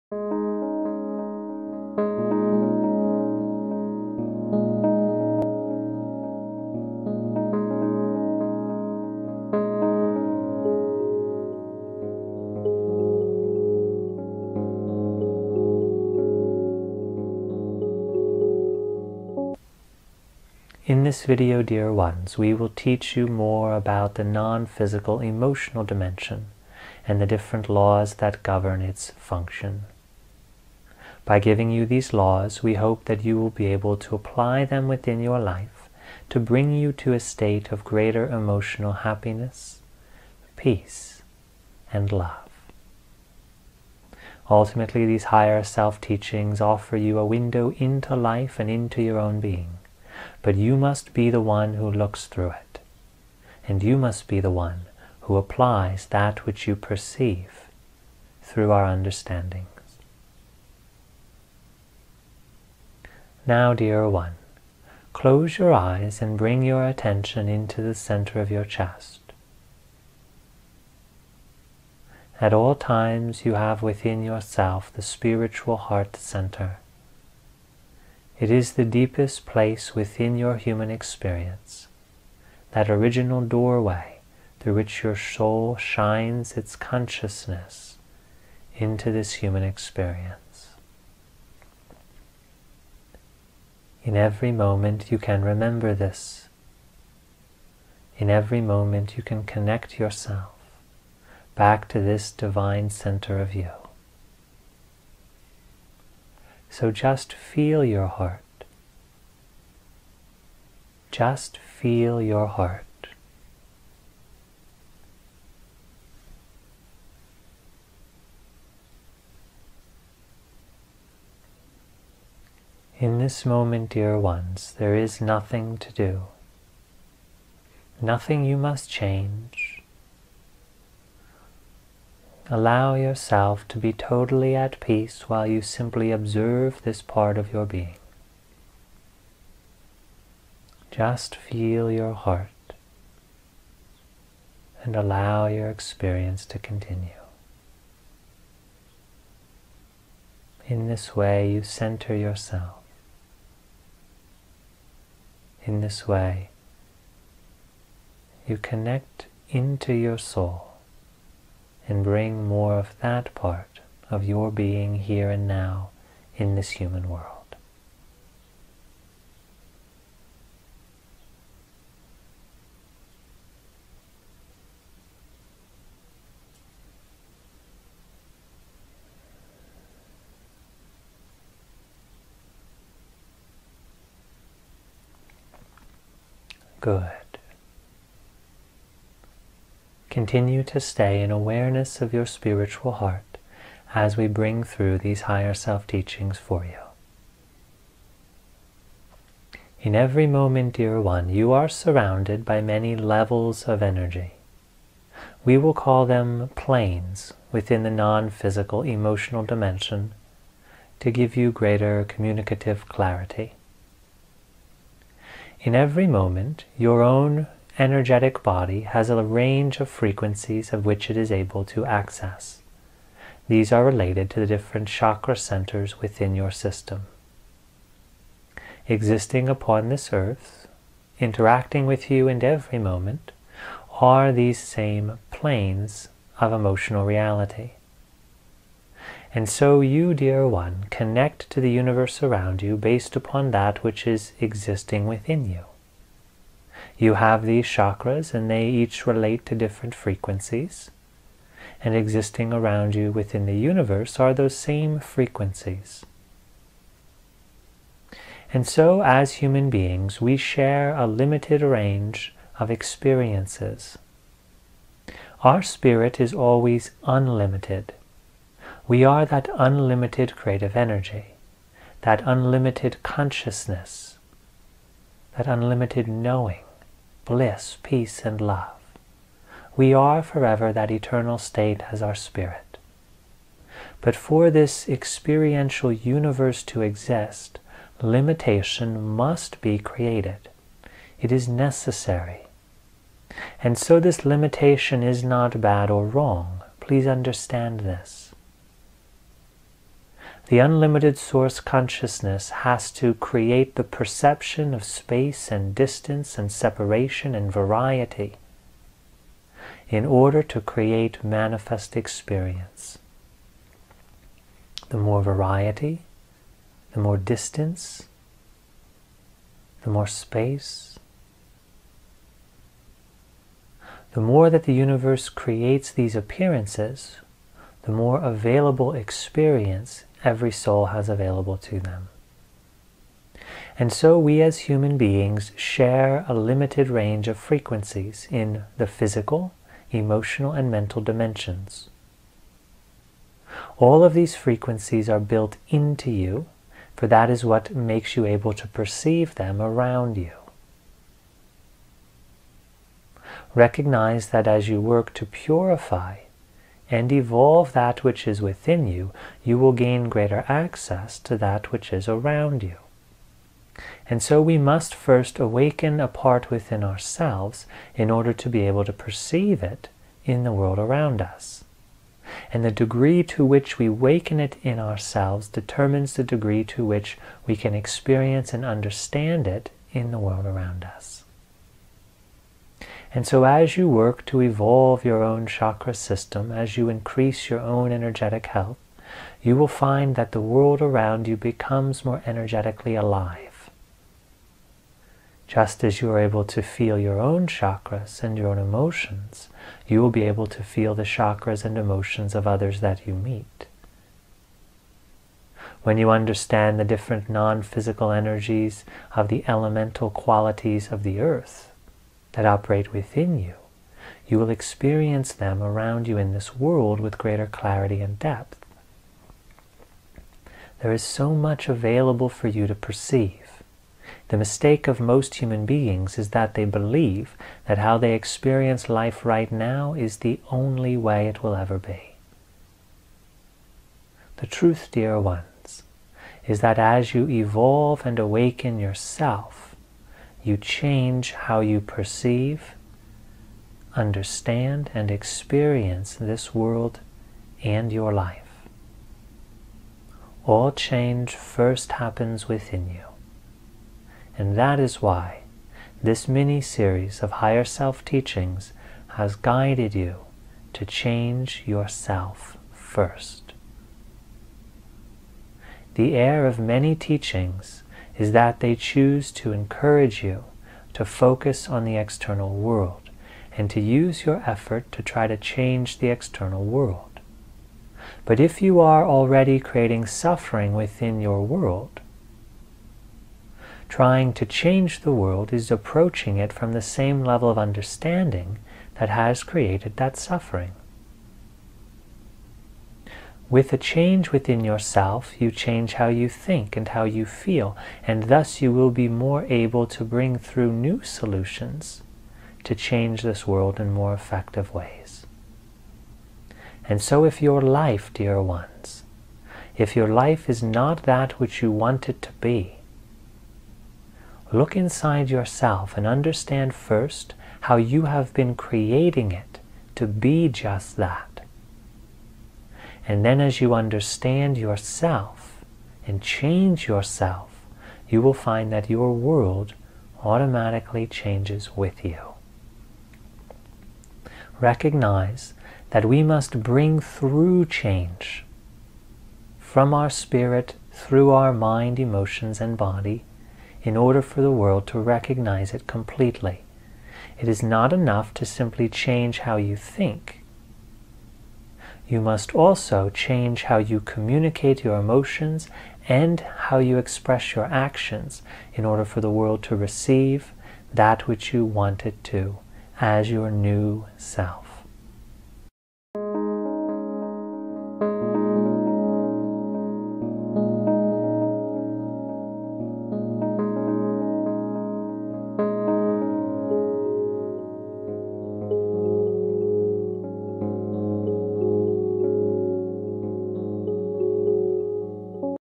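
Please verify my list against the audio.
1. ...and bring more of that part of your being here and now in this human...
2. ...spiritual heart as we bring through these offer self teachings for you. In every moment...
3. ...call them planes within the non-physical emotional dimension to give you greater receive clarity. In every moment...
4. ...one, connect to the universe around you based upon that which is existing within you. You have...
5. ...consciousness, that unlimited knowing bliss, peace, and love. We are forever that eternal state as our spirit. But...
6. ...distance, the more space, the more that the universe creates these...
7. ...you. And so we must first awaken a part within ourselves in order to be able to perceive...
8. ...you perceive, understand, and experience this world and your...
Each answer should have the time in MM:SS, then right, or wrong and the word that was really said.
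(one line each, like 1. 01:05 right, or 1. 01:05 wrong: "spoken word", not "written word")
1. 02:41 right
2. 03:12 wrong: "higher", not "offer"
3. 03:25 wrong: "communicative", not "receive"
4. 04:00 right
5. 04:33 right
6. 05:17 right
7. 06:02 right
8. 07:21 right.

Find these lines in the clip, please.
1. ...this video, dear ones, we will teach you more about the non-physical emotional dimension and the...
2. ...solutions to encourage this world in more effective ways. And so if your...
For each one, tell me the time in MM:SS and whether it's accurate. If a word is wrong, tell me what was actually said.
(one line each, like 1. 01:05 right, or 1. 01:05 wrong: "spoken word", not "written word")
1. 00:21 right
2. 08:21 wrong: "change", not "encourage".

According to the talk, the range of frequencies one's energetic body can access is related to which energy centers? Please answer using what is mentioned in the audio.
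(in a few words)
chakra centers.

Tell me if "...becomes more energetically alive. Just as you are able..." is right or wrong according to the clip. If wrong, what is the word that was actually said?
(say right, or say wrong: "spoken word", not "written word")
right.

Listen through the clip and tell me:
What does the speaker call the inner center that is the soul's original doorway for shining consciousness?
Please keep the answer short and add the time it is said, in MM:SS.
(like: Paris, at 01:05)
spiritual heart center, at 01:15.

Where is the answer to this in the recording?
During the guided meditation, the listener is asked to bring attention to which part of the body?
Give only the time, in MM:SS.
01:07.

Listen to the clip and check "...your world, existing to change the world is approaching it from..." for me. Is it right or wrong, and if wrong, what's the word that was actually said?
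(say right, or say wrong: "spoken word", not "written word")
wrong: "trying", not "existing".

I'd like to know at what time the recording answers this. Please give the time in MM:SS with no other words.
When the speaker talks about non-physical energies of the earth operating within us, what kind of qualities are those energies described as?
06:49.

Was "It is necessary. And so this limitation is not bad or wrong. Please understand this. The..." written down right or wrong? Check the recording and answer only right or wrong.
right.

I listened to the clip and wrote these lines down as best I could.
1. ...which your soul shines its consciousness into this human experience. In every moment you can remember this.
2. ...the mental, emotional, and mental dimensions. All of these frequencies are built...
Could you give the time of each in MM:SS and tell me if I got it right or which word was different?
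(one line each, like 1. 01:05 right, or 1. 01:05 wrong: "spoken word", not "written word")
1. 01:24 right
2. 05:38 wrong: "physical", not "mental".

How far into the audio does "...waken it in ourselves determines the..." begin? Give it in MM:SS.
06:13.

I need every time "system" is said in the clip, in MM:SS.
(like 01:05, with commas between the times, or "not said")
03:46, 06:25.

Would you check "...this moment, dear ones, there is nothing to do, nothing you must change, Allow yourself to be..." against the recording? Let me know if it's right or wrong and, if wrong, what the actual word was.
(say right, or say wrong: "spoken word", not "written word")
right.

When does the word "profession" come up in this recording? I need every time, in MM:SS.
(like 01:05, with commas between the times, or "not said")
not said.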